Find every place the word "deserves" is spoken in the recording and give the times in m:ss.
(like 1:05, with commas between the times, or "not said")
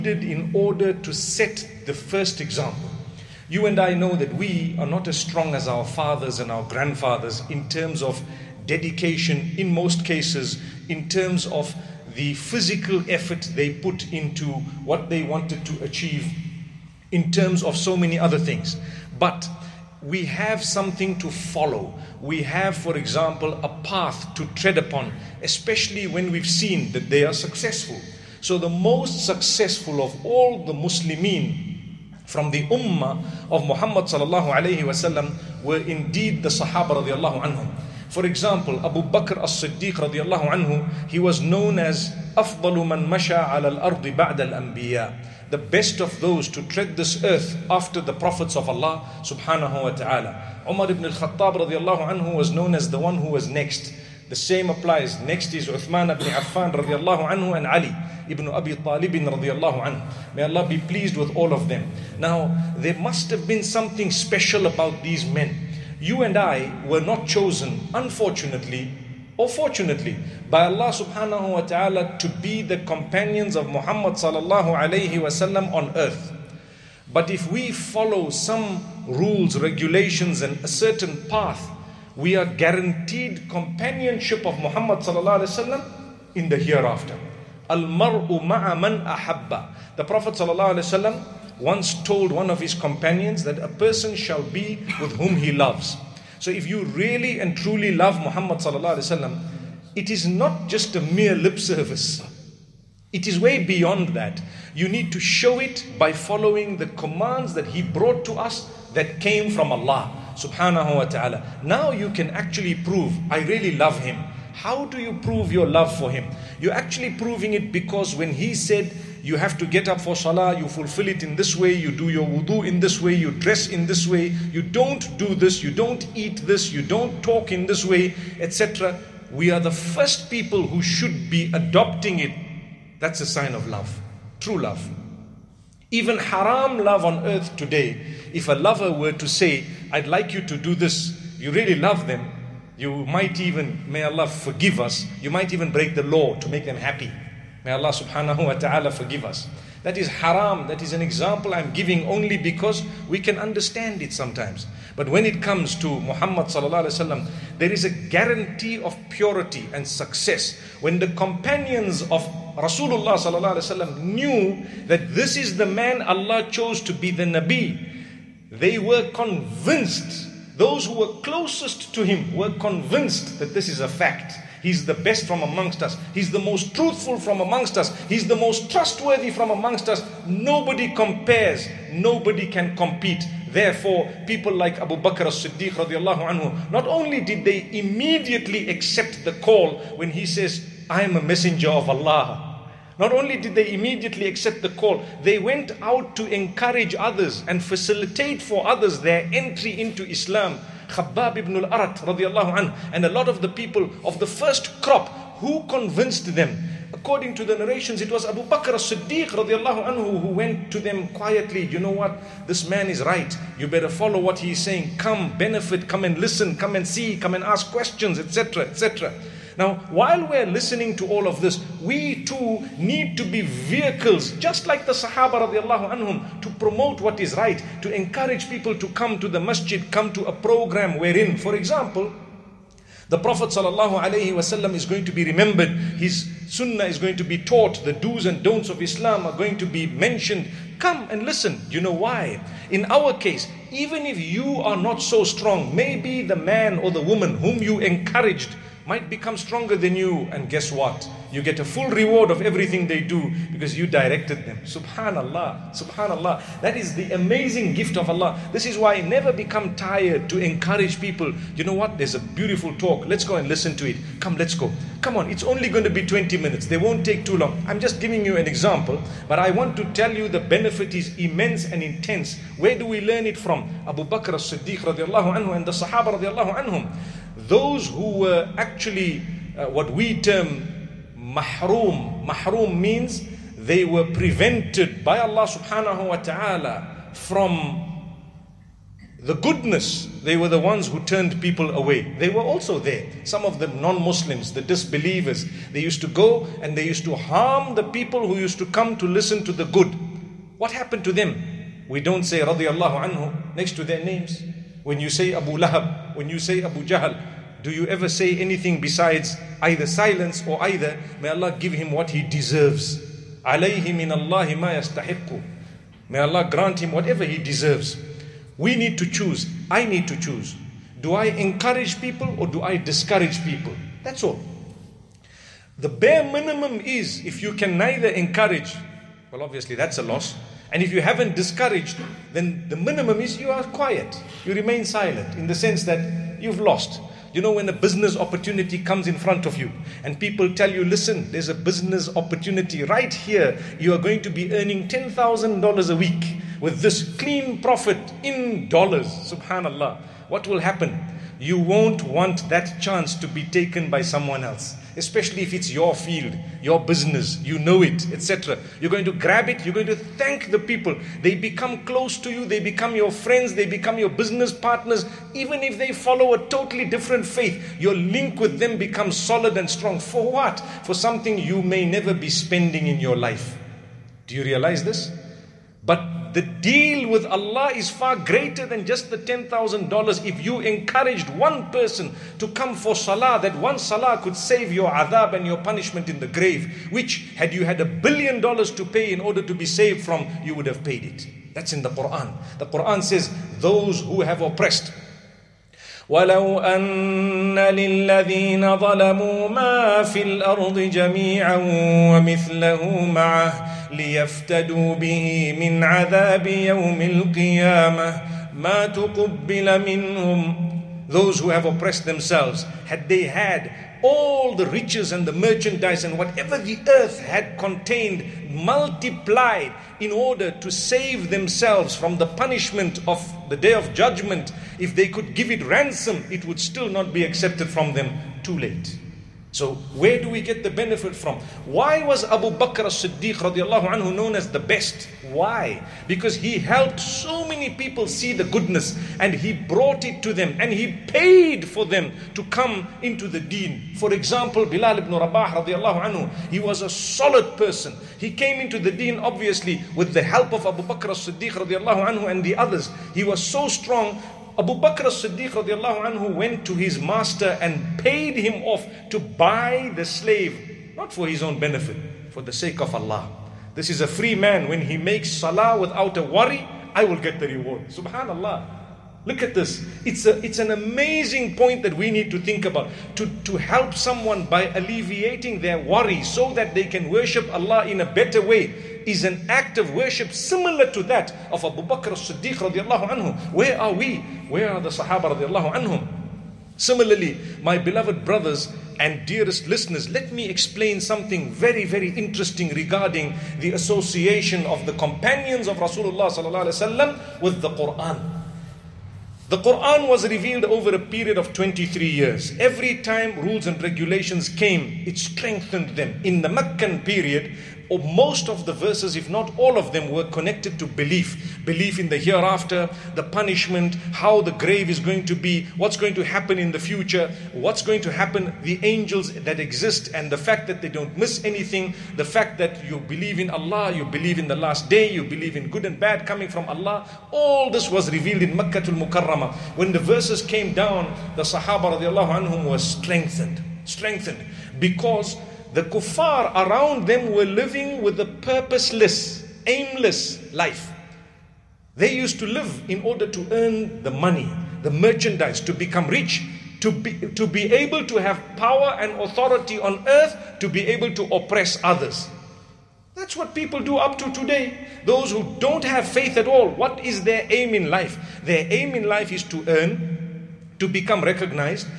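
5:12, 5:17.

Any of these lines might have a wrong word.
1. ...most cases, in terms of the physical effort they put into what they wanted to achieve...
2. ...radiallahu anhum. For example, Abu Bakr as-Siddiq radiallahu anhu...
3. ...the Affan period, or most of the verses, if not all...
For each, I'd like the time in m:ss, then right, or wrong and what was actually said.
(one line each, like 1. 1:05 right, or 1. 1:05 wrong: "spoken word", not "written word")
1. 0:09 right
2. 0:37 right
3. 8:26 wrong: "Meccan", not "Affan".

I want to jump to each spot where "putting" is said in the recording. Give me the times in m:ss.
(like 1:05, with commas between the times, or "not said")
not said.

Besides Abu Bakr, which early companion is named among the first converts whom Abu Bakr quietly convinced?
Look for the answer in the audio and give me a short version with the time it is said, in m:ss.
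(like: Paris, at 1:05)
Khabbab ibn al-Arat, at 3:20.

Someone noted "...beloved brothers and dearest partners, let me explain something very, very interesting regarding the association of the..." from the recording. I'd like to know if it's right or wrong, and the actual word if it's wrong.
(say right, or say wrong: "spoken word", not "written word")
wrong: "listeners", not "partners".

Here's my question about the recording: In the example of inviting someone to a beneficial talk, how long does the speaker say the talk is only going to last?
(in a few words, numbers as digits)
20 minutes.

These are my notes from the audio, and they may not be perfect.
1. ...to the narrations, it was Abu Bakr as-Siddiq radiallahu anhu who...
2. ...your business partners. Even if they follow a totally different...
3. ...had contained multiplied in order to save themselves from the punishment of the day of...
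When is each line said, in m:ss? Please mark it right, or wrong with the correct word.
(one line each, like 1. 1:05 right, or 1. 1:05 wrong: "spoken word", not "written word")
1. 3:27 right
2. 6:03 right
3. 6:57 right.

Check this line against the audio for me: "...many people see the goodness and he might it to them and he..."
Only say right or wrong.
wrong.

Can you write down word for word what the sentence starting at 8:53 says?
Strengthened because the kuffar around them were living with a purposeless, aimless life.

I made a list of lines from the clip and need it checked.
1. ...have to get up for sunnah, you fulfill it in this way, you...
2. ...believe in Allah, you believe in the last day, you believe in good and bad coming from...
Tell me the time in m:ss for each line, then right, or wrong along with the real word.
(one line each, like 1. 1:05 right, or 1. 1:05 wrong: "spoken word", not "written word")
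1. 1:59 wrong: "salah", not "sunnah"
2. 8:42 right.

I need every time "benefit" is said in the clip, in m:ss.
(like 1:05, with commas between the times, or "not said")
3:35, 4:30, 7:10, 7:41.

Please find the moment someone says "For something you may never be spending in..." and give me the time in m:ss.
6:10.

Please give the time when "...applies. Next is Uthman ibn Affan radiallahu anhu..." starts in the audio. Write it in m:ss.
0:54.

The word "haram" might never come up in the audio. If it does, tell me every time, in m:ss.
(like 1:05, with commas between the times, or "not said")
2:16, 2:30.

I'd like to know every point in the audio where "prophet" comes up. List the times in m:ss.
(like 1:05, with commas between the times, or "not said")
0:48, 1:30, 3:53.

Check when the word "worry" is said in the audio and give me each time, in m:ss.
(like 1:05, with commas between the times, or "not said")
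7:46, 7:55.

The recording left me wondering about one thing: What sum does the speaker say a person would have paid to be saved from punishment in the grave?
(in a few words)
a billion dollars.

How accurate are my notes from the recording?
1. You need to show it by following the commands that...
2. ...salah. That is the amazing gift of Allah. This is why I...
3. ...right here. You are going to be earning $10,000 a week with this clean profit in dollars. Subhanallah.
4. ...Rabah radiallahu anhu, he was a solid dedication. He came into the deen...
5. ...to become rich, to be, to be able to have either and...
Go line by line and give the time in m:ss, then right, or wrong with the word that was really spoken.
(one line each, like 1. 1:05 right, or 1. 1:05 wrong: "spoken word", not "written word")
1. 1:44 right
2. 4:15 wrong: "subhanallah", not "salah"
3. 5:42 right
4. 7:25 wrong: "person", not "dedication"
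5. 9:05 wrong: "power", not "either".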